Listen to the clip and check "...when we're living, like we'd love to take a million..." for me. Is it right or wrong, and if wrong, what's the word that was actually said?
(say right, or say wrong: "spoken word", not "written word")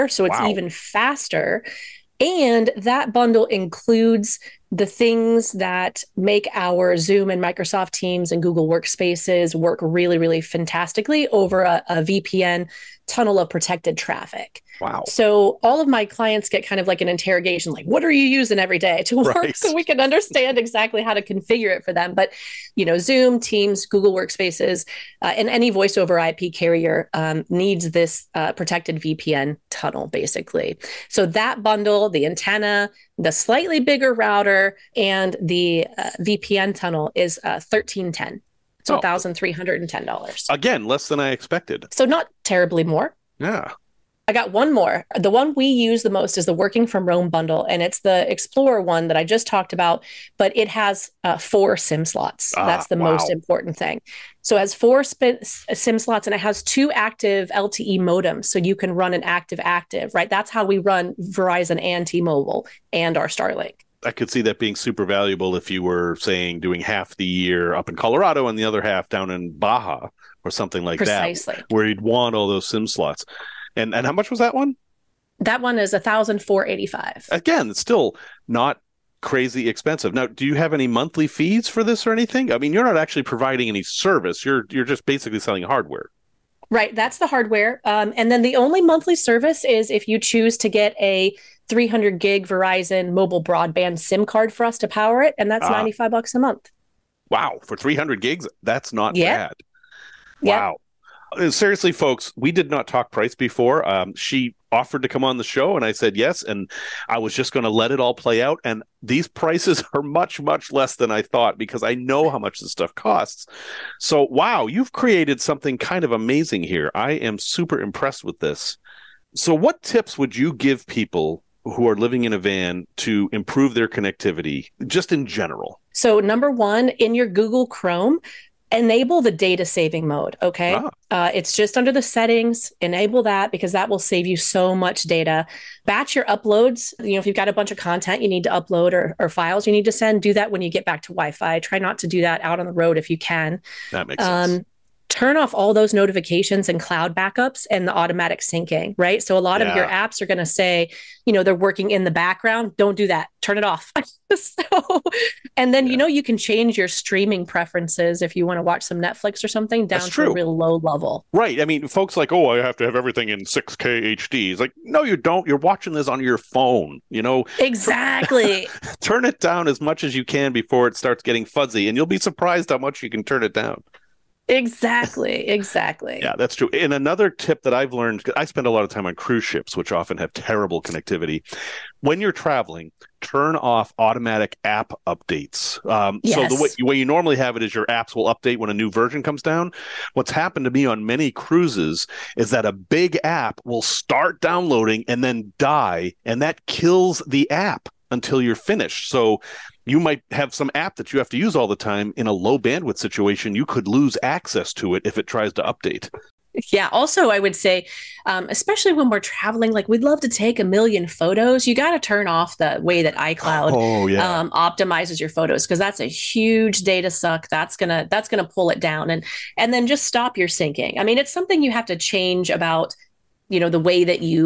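wrong: "traveling", not "living".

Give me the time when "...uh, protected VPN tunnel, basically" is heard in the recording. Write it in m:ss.
0:28.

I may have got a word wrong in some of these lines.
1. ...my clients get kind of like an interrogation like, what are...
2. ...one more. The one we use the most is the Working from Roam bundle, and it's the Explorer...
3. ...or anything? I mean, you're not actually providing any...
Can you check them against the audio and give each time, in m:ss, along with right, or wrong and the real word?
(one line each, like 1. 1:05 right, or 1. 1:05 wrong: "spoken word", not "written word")
1. 0:15 right
2. 0:44 right
3. 1:22 right.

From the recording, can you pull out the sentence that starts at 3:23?
You could lose access to it if it tries to update.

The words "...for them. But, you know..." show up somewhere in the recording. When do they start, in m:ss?
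0:21.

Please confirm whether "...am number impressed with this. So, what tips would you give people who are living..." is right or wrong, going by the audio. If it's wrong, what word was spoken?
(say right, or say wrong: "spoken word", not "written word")
wrong: "super", not "number".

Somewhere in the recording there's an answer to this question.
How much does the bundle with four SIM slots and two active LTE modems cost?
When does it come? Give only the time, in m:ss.
1:15.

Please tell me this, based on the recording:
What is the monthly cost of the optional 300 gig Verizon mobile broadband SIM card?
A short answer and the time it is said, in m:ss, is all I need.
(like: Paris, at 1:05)
$95, at 1:35.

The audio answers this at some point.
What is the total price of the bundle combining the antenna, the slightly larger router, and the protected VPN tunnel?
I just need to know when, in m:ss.
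0:37.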